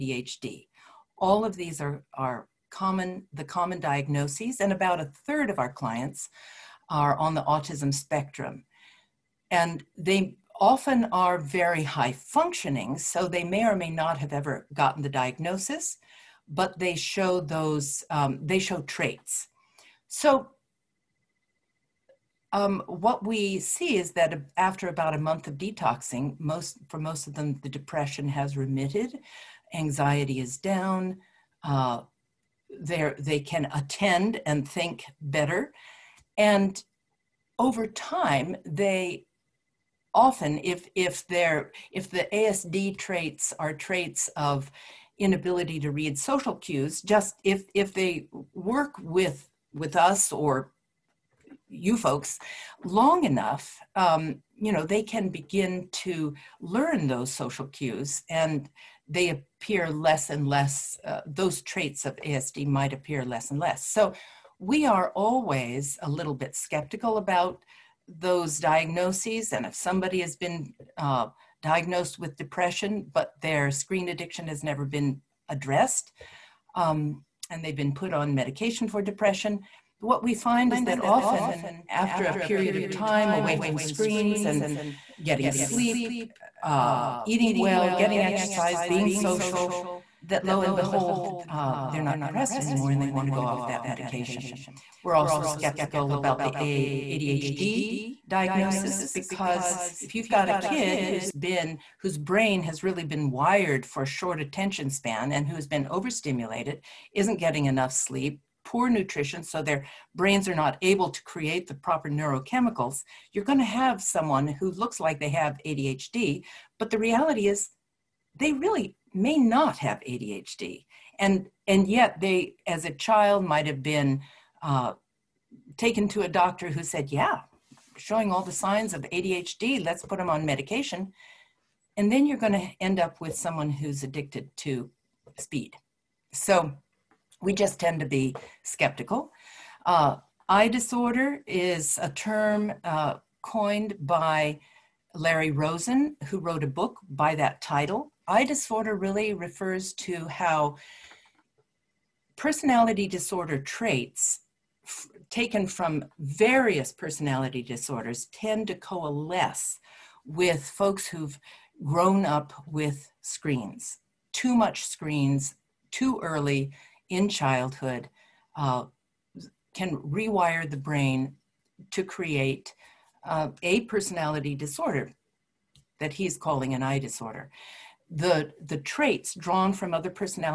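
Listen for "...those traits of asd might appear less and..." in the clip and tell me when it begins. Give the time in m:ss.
1:01.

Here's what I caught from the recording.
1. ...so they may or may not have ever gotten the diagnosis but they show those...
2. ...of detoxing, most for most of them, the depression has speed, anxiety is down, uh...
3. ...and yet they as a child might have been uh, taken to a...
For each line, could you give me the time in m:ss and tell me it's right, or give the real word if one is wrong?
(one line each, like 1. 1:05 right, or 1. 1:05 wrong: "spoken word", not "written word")
1. 0:12 right
2. 0:25 wrong: "remitted", not "speed"
3. 2:01 right.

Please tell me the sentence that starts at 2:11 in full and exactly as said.
And then you're going to end up with someone who's addicted to speed.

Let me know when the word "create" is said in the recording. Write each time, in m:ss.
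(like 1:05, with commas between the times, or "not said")
1:51, 2:52.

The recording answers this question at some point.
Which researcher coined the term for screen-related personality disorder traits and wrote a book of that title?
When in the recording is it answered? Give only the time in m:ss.
2:25.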